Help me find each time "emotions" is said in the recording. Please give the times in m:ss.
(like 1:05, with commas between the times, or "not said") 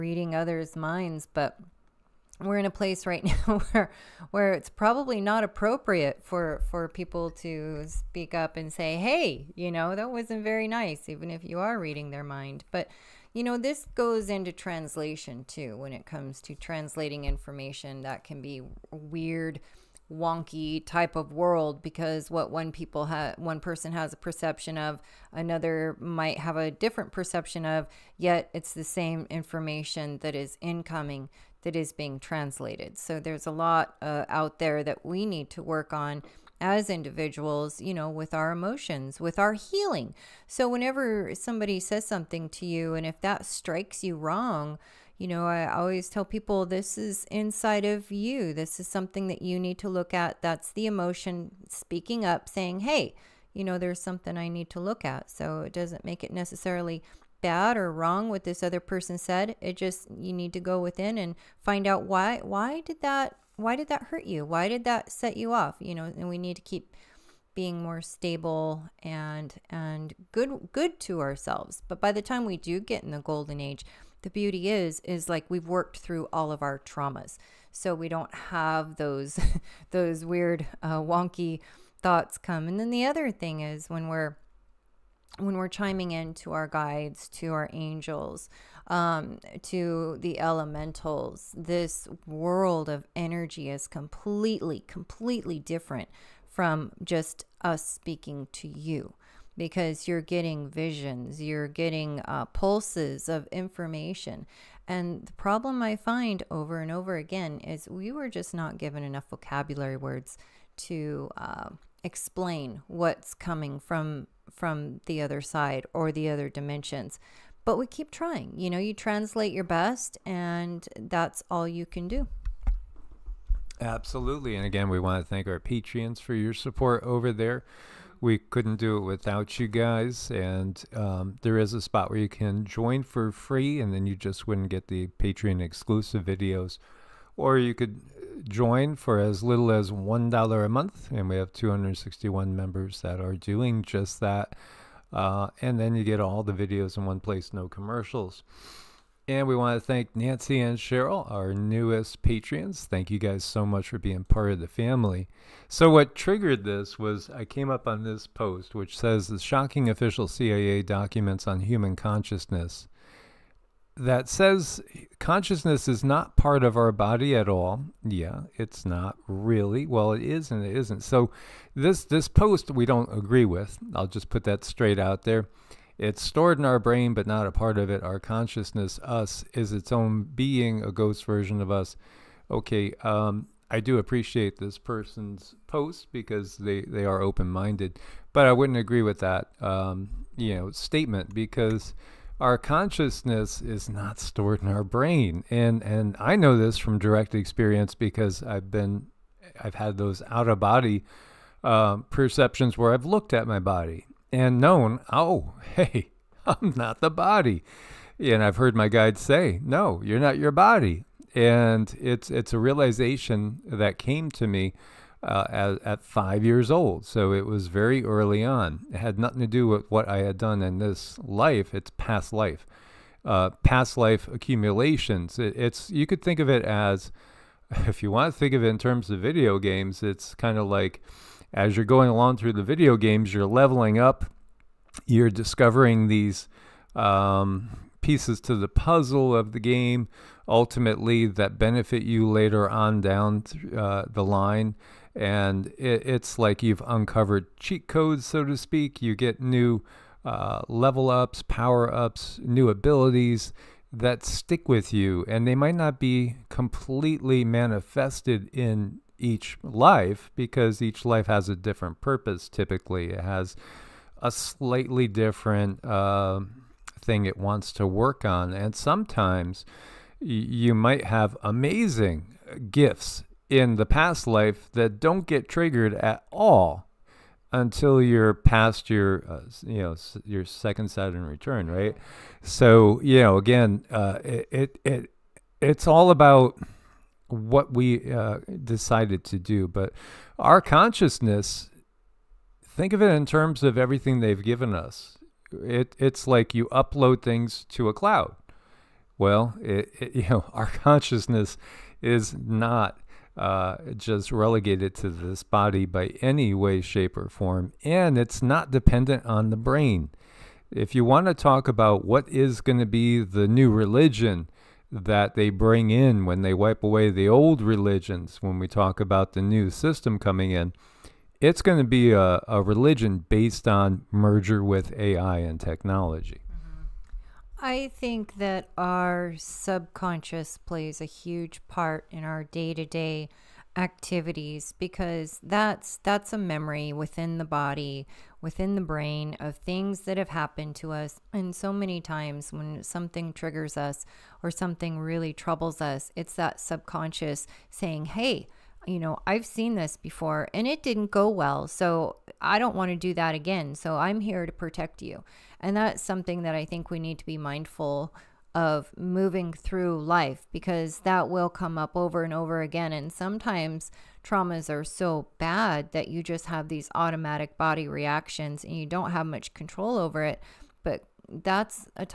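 0:38, 0:50.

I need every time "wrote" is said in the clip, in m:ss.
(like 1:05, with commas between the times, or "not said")
not said.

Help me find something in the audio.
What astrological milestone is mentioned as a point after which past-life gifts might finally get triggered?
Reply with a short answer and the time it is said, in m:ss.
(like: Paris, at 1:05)
second Saturn return, at 4:40.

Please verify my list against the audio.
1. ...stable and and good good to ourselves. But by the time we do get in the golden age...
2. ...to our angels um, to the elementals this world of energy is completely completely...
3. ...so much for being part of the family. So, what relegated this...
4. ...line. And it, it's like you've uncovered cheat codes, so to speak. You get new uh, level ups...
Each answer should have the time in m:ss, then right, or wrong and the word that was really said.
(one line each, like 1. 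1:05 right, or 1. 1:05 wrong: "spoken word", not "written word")
1. 1:07 right
2. 1:27 right
3. 2:33 wrong: "triggered", not "relegated"
4. 4:04 right.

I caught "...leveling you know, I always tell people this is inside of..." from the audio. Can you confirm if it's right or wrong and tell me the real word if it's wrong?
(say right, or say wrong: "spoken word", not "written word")
wrong: "wrong", not "leveling".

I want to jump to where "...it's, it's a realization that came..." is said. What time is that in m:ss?
3:31.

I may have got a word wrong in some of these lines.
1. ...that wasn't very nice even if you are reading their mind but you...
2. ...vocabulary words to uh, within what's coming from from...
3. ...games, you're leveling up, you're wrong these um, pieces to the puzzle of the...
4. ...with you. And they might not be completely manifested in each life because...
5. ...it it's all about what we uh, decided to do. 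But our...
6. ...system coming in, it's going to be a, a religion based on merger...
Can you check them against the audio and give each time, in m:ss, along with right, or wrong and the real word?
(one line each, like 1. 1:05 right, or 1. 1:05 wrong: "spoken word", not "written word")
1. 0:09 right
2. 1:49 wrong: "explain", not "within"
3. 3:52 wrong: "discovering", not "wrong"
4. 4:14 right
5. 4:44 right
6. 5:19 right.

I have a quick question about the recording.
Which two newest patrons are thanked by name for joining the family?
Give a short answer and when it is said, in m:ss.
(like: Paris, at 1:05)
Nancy and Cheryl, at 2:30.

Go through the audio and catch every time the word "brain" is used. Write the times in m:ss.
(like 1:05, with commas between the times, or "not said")
2:56, 3:14, 5:09, 5:38.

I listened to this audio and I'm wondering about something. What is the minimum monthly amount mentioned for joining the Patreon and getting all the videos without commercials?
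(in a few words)
$1.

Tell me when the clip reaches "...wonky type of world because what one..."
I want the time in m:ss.
0:20.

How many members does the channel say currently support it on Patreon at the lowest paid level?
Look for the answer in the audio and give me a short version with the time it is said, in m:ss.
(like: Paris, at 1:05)
261, at 2:21.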